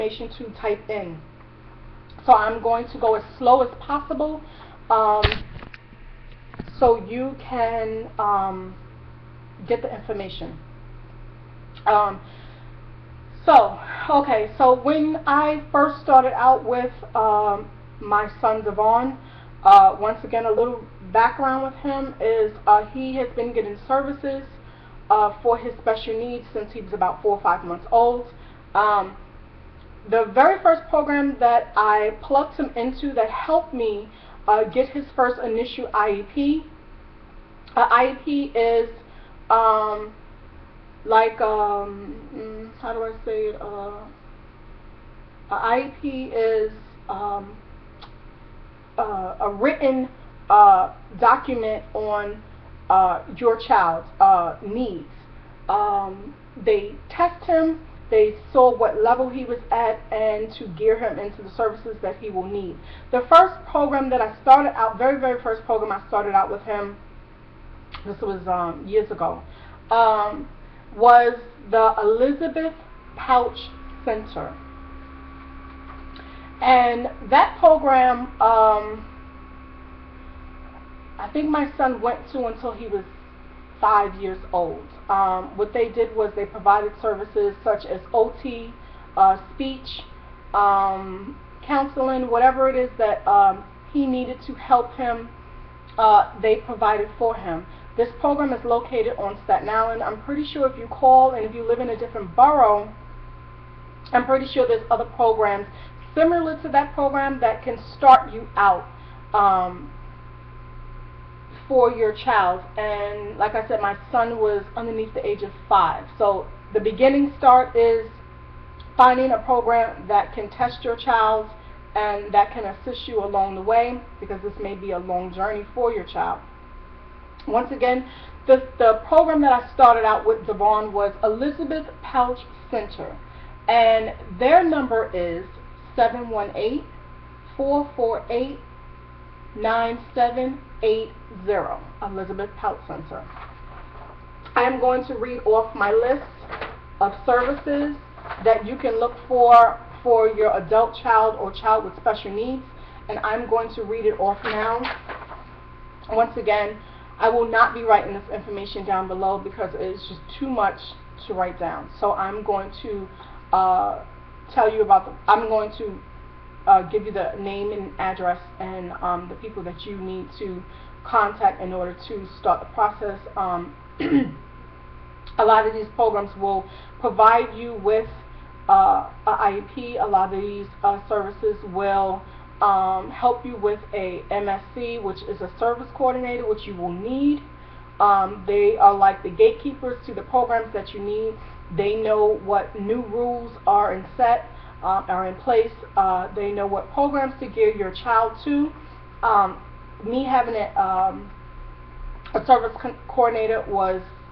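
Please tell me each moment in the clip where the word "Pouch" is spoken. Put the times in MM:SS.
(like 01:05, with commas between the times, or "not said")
01:13, 02:12.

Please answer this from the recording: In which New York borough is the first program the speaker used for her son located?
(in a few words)
Staten Island.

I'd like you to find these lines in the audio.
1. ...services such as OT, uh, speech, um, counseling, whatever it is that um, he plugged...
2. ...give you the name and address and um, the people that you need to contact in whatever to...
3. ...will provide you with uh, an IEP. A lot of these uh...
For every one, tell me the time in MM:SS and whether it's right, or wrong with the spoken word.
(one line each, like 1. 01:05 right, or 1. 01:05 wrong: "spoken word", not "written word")
1. 01:27 wrong: "needed", not "plugged"
2. 02:46 wrong: "order", not "whatever"
3. 02:56 right.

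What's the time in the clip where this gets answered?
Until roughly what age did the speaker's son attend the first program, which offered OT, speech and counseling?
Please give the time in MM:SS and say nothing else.
01:23.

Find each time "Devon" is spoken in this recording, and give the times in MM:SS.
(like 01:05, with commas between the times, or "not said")
00:18, 02:10.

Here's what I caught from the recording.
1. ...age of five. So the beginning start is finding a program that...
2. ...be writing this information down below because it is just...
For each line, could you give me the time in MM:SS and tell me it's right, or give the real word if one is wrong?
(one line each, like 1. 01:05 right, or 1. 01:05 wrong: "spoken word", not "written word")
1. 01:55 right
2. 02:37 right.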